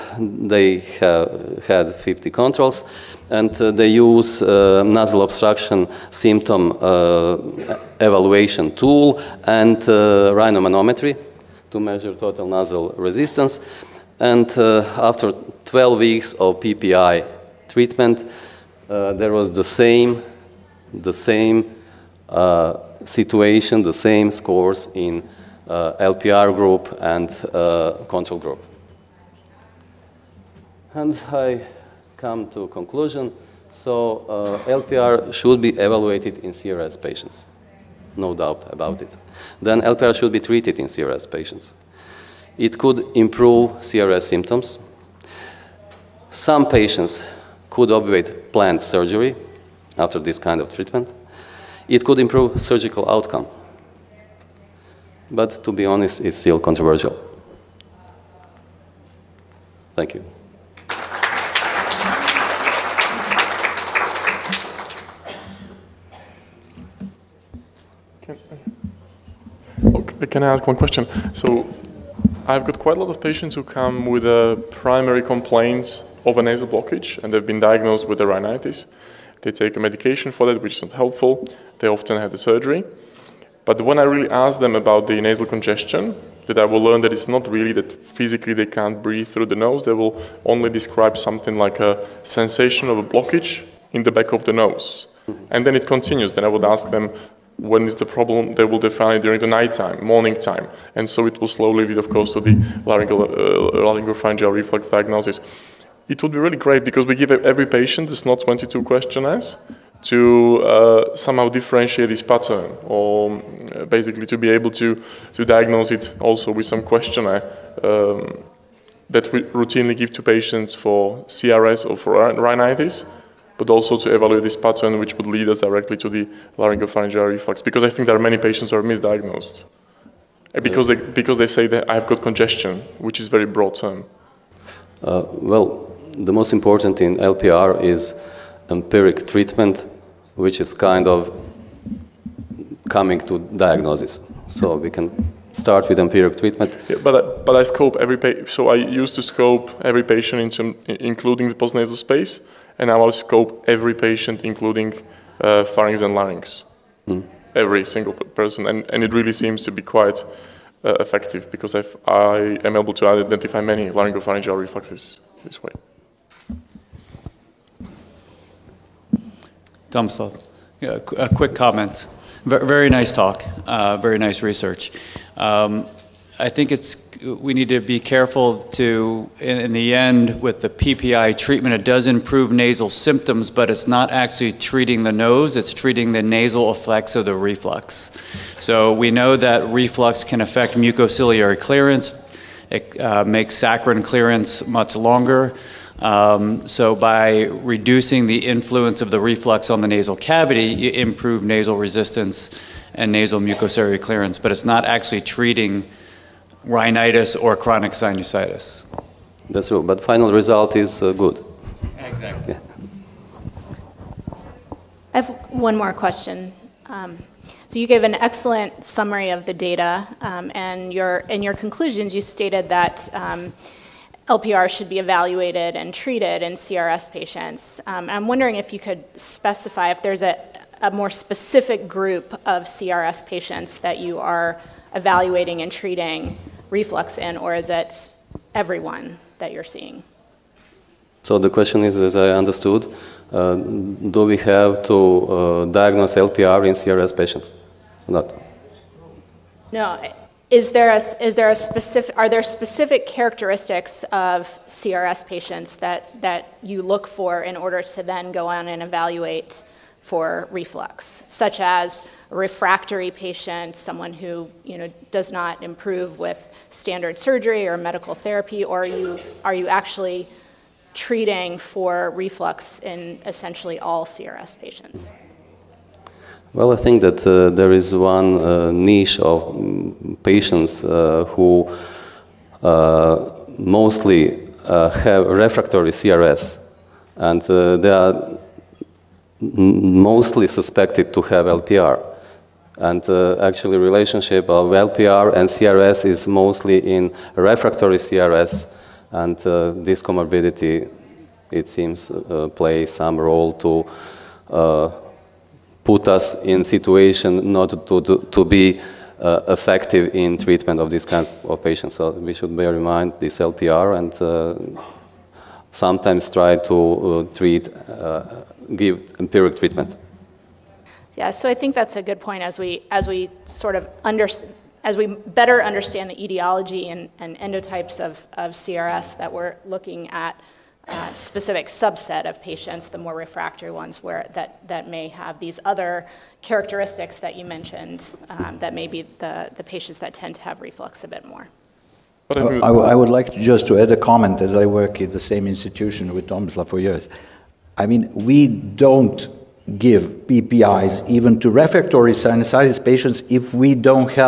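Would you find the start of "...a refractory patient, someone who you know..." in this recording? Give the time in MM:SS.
04:22.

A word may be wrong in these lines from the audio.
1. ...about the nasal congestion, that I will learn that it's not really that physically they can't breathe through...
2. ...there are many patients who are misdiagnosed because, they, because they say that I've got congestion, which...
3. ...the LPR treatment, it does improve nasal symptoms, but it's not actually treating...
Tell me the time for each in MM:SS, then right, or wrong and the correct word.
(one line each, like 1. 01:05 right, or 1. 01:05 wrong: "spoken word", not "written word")
1. 01:24 right
2. 02:08 right
3. 03:00 wrong: "PPI", not "LPR".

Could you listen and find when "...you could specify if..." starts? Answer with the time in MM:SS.
03:48.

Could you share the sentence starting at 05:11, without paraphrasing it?
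So we should bear in mind this LPR and uh, sometimes try to uh, treat, uh, give empiric treatment.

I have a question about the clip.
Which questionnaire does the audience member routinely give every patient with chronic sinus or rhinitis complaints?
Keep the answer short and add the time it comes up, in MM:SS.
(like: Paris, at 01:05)
SNOT-22, at 01:48.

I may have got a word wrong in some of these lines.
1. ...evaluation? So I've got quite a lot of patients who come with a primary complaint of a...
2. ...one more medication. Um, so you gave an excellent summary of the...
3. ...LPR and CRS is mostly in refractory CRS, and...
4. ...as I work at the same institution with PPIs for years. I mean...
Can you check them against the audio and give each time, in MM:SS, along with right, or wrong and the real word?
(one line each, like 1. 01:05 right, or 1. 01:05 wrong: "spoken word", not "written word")
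1. 01:10 wrong: "question", not "evaluation"
2. 03:35 wrong: "question", not "medication"
3. 04:54 right
4. 05:44 wrong: "Tomislav", not "PPIs".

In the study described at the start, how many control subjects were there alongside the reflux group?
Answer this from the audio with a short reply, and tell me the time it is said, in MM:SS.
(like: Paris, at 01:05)
50, at 00:01.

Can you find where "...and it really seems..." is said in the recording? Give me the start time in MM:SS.
02:38.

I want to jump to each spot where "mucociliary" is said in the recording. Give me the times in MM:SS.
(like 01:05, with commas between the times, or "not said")
03:10, 03:23.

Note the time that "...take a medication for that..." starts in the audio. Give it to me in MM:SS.
01:19.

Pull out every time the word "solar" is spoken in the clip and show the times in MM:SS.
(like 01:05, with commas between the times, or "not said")
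not said.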